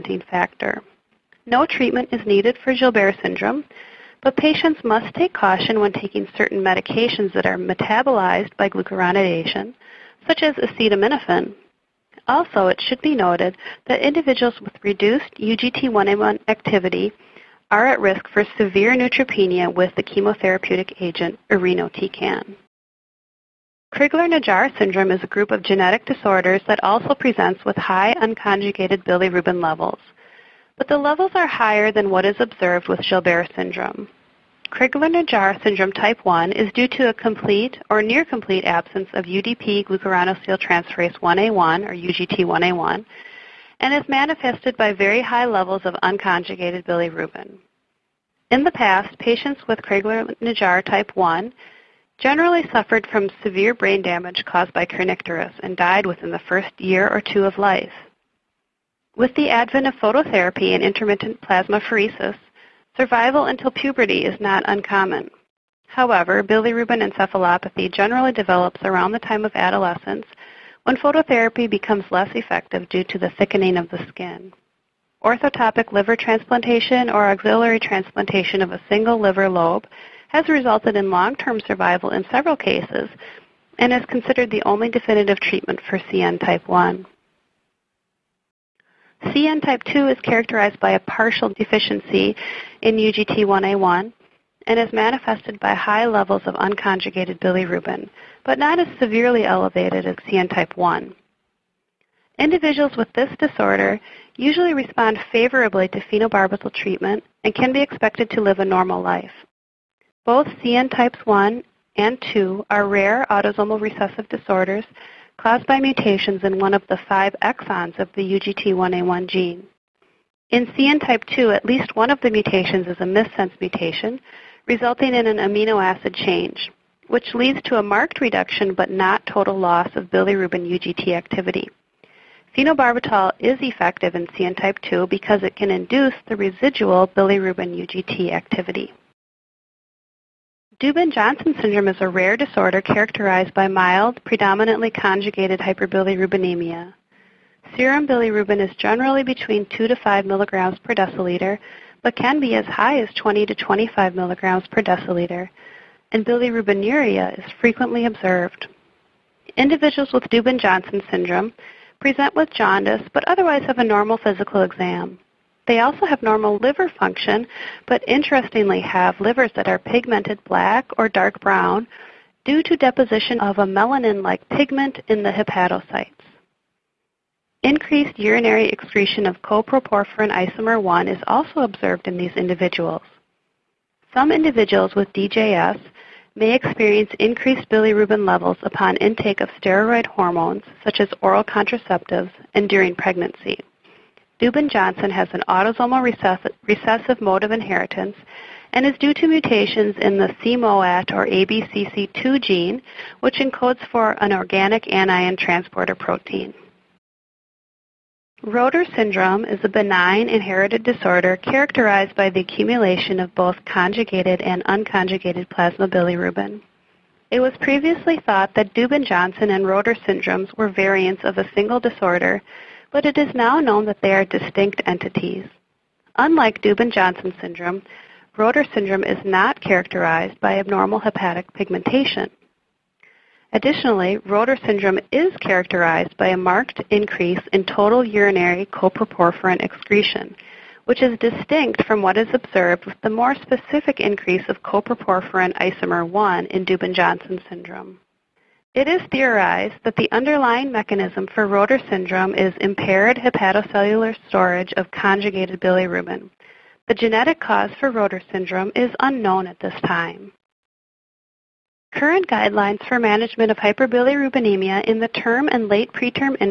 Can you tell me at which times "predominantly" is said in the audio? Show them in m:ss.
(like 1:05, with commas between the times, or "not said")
2:24.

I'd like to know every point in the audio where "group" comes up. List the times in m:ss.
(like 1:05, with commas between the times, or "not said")
0:25.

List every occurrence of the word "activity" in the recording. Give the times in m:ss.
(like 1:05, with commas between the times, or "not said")
0:16, 2:11, 2:18.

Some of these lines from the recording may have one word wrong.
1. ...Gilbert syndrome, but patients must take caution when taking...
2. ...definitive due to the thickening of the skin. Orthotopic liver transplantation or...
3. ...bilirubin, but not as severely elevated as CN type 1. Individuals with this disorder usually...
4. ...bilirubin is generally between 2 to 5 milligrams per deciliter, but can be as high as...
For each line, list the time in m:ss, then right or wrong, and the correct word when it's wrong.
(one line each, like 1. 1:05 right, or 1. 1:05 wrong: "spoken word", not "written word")
1. 0:02 right
2. 1:12 wrong: "effective", not "definitive"
3. 1:37 right
4. 2:28 right.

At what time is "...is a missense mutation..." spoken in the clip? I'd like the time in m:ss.
2:02.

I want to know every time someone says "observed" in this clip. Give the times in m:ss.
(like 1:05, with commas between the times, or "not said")
0:32, 2:38, 3:01, 4:02.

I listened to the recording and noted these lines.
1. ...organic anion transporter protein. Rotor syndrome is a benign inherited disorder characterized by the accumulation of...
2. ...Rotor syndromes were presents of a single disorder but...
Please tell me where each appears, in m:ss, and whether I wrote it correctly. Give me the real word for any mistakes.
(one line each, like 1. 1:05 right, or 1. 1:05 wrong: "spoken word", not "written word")
1. 3:24 right
2. 3:39 wrong: "variants", not "presents".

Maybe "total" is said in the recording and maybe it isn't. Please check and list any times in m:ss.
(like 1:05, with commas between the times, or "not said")
2:09, 3:57.